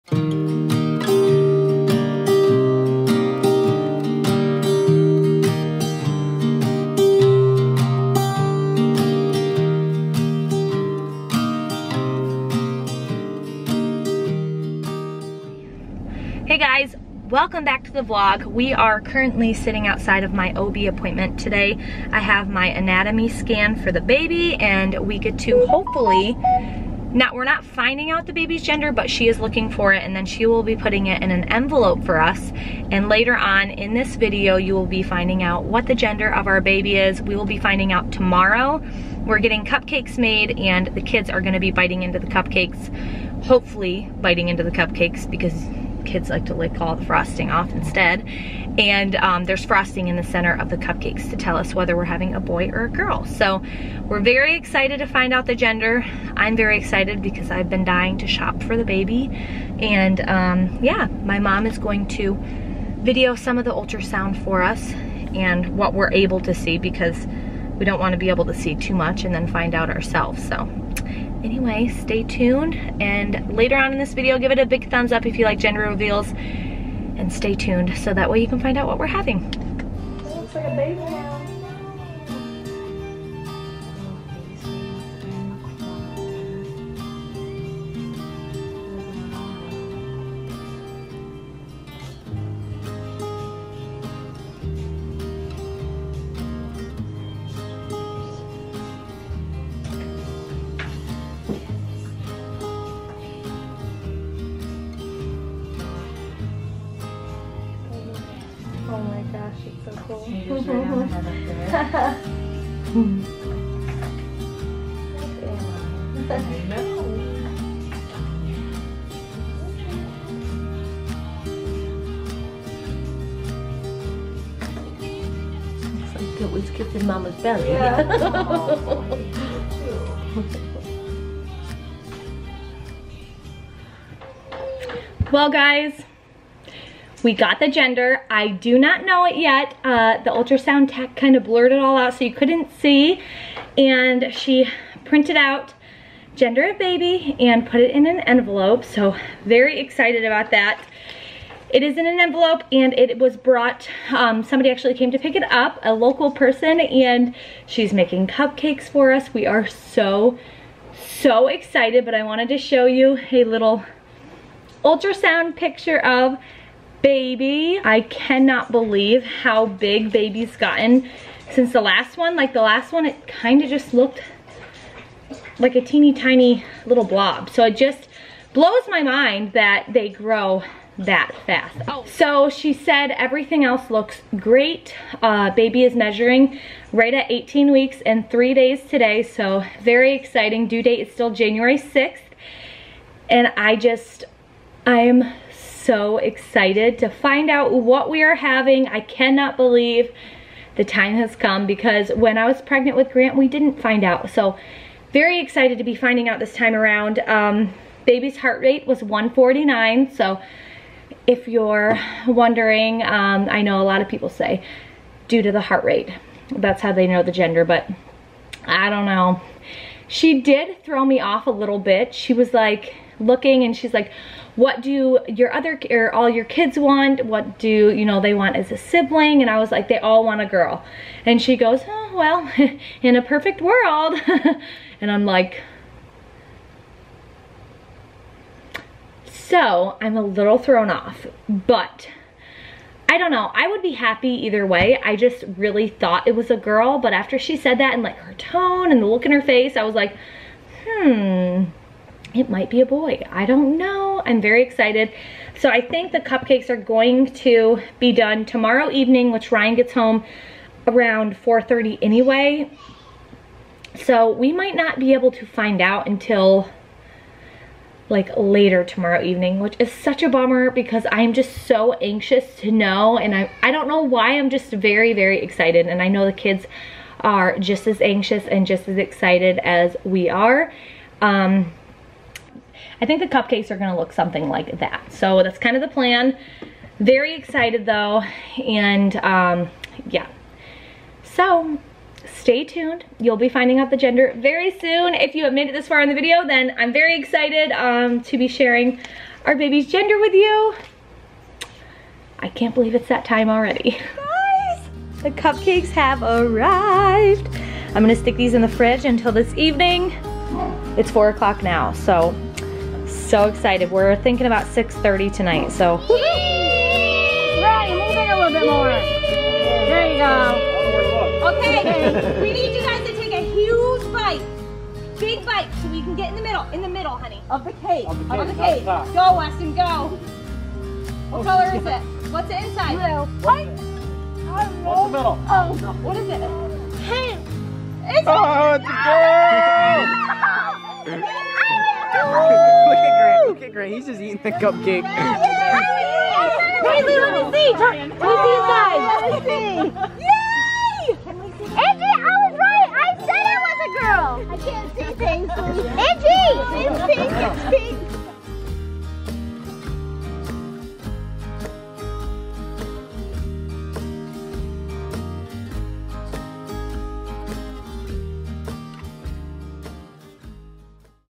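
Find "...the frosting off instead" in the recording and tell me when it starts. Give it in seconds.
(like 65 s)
46 s.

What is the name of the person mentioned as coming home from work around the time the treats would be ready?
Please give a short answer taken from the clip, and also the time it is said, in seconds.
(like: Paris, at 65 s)
Ryan, at 259 s.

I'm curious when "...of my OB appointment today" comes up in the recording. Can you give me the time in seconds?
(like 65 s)
20 s.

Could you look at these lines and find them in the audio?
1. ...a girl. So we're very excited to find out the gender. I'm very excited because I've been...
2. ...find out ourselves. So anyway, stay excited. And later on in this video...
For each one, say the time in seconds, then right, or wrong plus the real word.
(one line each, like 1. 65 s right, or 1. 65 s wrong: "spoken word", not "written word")
1. 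52 s right
2. 69 s wrong: "tuned", not "excited".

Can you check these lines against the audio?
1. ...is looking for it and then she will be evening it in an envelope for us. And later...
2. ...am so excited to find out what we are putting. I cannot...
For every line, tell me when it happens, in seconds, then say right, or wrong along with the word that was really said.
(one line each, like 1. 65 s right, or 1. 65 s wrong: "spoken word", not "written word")
1. 29 s wrong: "putting", not "evening"
2. 194 s wrong: "having", not "putting".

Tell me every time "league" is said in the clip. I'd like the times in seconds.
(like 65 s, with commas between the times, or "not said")
not said.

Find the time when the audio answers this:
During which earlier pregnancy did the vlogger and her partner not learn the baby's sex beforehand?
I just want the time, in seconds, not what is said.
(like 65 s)
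203 s.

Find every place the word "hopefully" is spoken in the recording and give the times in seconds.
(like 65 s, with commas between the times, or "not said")
25 s, 43 s.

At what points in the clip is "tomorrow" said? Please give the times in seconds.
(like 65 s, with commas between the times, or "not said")
38 s, 258 s, 268 s.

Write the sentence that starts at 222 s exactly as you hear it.
She was like looking and she's like, what do your other or all your kids want?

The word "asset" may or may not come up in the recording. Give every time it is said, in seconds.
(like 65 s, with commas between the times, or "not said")
not said.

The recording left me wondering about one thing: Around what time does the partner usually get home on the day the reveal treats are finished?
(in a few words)
4:30.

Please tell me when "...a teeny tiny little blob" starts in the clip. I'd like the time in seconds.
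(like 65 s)
175 s.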